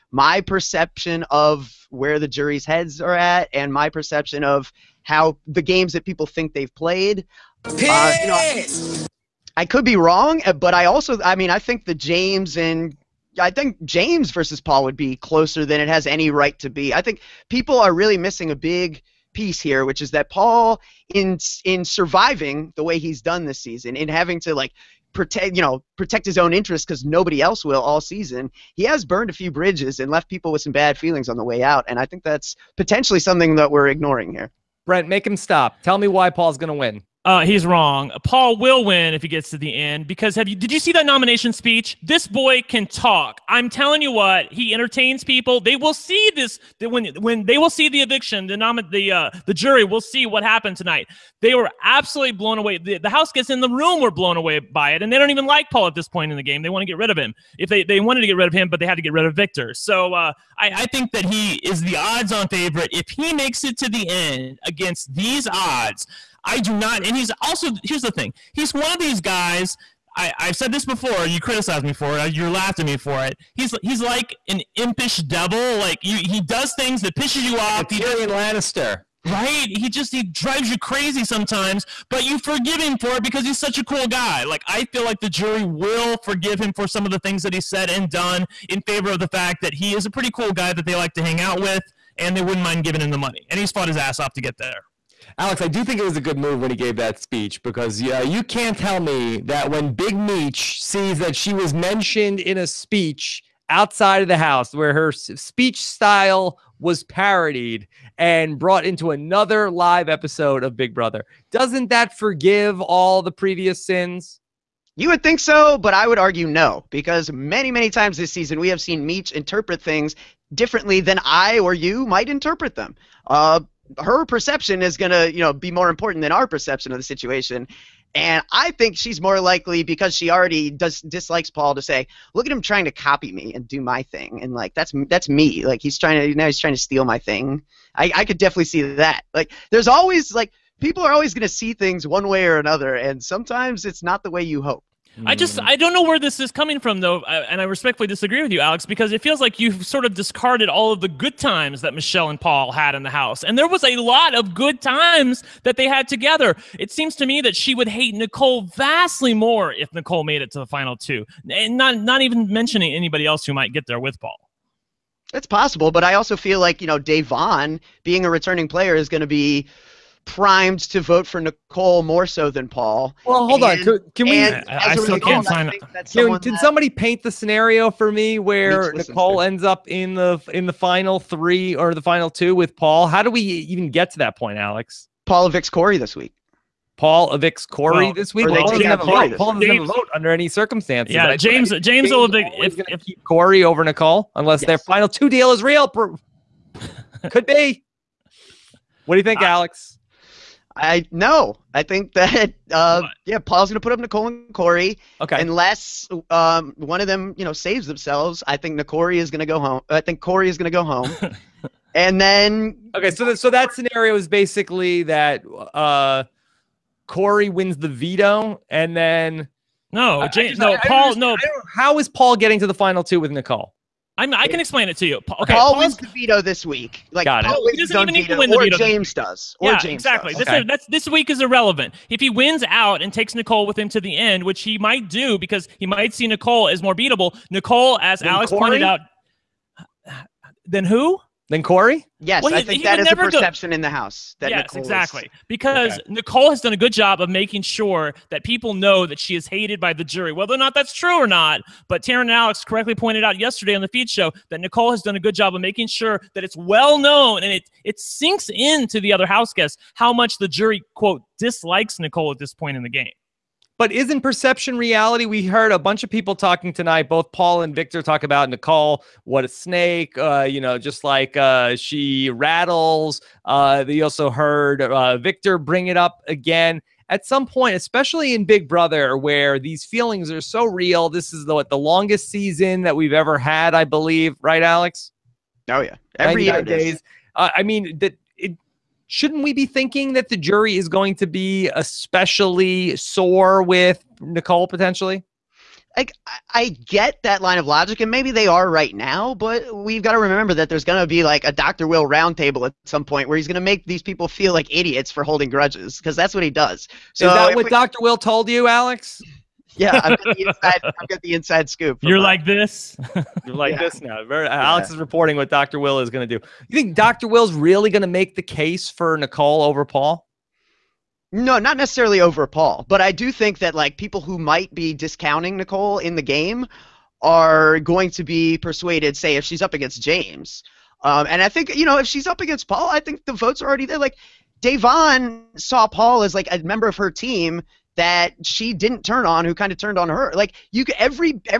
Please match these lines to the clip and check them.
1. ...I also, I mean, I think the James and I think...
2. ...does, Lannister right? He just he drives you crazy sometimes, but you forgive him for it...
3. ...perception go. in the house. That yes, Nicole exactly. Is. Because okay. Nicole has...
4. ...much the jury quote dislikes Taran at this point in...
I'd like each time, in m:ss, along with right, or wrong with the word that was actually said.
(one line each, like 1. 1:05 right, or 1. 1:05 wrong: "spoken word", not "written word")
1. 0:10 right
2. 1:18 right
3. 4:03 right
4. 4:20 wrong: "Nicole", not "Taran".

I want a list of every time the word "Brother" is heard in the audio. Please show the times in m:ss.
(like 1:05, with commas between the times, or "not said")
1:50, 4:38.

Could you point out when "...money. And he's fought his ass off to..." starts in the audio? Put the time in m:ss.
1:33.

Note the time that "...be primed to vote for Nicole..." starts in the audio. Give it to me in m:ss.
2:49.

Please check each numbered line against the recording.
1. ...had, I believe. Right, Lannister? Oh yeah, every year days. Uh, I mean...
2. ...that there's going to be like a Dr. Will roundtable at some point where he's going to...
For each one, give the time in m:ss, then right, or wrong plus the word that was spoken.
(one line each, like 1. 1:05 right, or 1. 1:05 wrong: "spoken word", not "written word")
1. 4:43 wrong: "Alex", not "Lannister"
2. 5:00 right.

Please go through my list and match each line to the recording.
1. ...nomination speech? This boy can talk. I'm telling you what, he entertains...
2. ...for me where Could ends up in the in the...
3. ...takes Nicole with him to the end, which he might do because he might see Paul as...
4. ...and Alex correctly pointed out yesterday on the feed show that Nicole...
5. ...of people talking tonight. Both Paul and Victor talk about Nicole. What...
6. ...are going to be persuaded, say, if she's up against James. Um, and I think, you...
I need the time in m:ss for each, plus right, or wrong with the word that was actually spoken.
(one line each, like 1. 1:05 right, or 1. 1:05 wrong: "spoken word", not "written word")
1. 0:41 right
2. 2:57 wrong: "Nicole", not "Could"
3. 3:53 wrong: "Nicole", not "Paul"
4. 4:12 right
5. 4:26 right
6. 5:27 right.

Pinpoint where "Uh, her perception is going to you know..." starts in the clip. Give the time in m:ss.
2:03.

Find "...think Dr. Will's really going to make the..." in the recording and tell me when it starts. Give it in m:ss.
5:16.